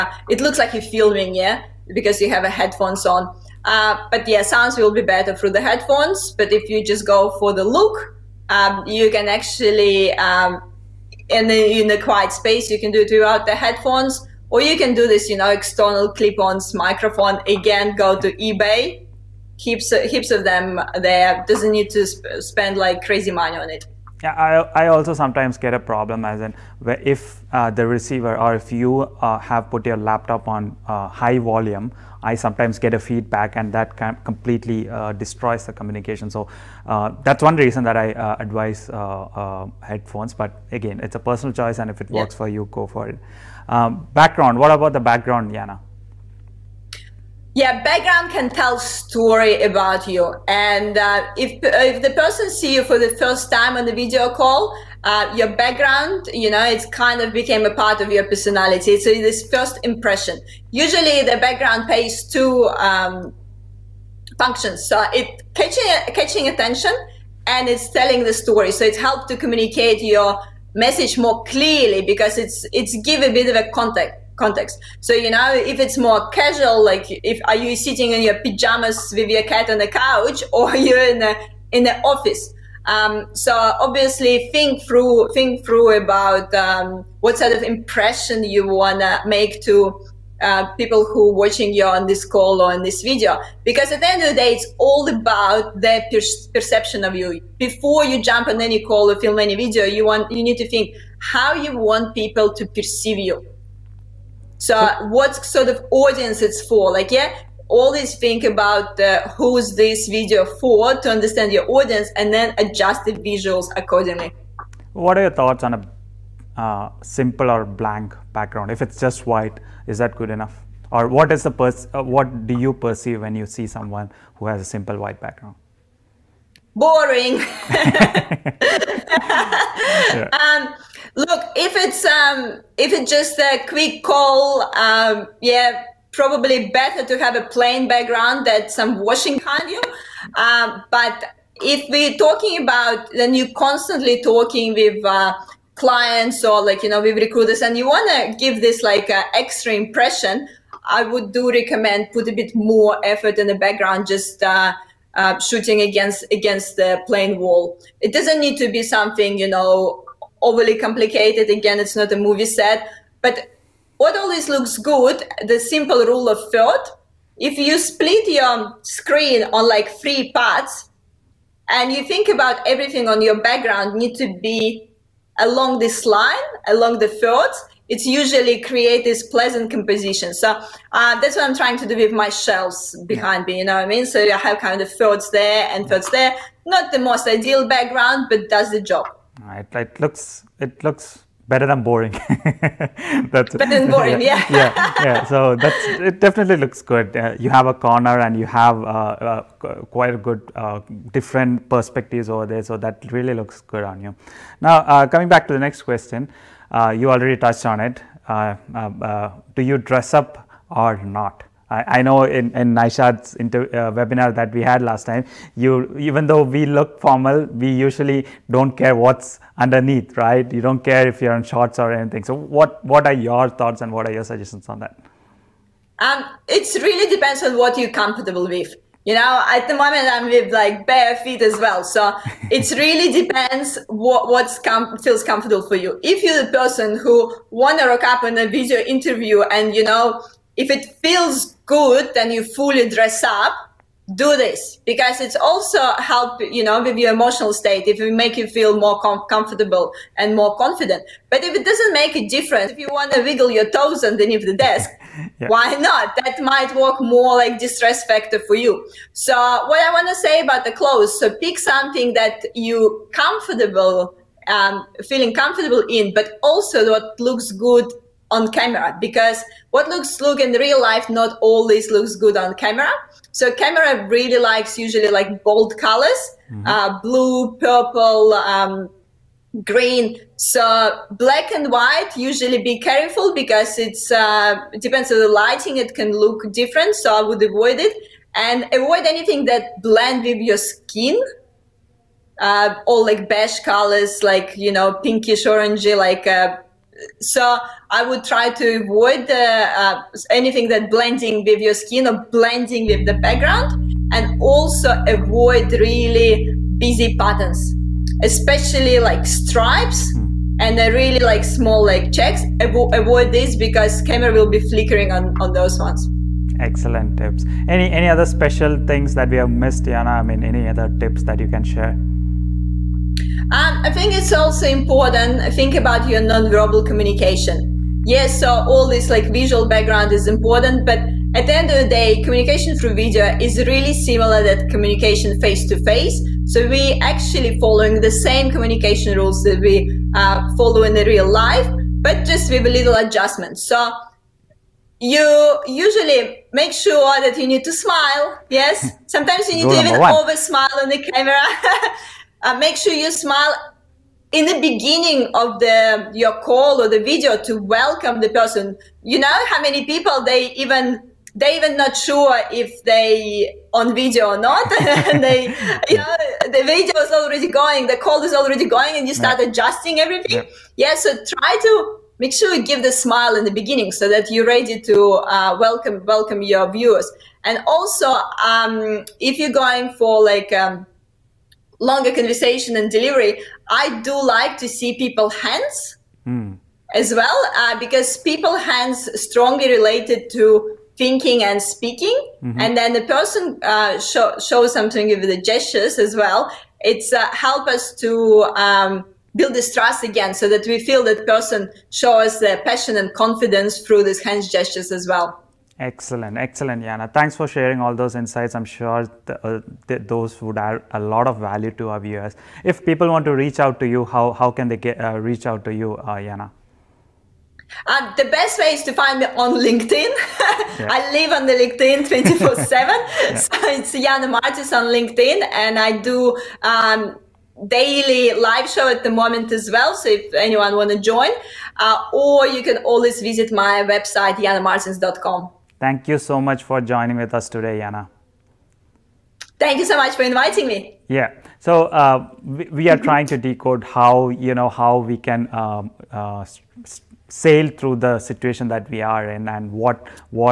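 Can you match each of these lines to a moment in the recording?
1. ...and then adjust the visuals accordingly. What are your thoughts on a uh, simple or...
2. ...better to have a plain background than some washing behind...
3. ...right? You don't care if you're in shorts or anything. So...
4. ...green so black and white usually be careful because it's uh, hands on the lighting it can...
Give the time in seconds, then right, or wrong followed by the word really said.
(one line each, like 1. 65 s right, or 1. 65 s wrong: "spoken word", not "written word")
1. 112 s right
2. 136 s right
3. 220 s right
4. 279 s wrong: "depends", not "hands".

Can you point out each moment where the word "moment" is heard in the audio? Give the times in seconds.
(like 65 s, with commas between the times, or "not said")
229 s, 429 s.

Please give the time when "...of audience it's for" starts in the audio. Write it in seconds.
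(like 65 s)
105 s.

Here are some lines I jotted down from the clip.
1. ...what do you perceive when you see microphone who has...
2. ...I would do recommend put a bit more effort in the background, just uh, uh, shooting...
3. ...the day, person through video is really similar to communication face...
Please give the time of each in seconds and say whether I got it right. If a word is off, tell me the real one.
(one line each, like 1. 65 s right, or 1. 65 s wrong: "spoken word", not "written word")
1. 122 s wrong: "someone", not "microphone"
2. 150 s right
3. 331 s wrong: "communication", not "person".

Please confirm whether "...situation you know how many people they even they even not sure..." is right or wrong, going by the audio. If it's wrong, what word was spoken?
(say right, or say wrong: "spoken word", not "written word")
wrong: "person", not "situation".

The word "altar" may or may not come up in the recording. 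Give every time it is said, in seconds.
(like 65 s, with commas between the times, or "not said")
not said.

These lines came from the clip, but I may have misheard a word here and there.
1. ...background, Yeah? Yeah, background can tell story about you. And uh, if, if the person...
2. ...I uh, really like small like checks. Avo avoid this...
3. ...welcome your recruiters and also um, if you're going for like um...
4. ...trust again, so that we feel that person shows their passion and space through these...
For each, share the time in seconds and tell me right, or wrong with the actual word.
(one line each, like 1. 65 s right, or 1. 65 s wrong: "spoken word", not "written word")
1. 44 s wrong: "Yana", not "Yeah"
2. 310 s right
3. 376 s wrong: "viewers", not "recruiters"
4. 399 s wrong: "confidence", not "space".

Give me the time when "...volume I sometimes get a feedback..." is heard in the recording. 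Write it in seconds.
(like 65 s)
31 s.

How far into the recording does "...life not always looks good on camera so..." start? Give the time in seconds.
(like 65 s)
270 s.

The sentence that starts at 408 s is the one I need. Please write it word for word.
I'm sure th uh, th those would add a lot of value to our viewers.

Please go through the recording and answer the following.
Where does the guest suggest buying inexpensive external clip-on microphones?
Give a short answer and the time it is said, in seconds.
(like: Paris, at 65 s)
eBay, at 18 s.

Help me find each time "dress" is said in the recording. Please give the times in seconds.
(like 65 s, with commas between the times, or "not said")
209 s, 242 s.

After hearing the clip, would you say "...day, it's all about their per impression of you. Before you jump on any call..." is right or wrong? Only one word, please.
wrong.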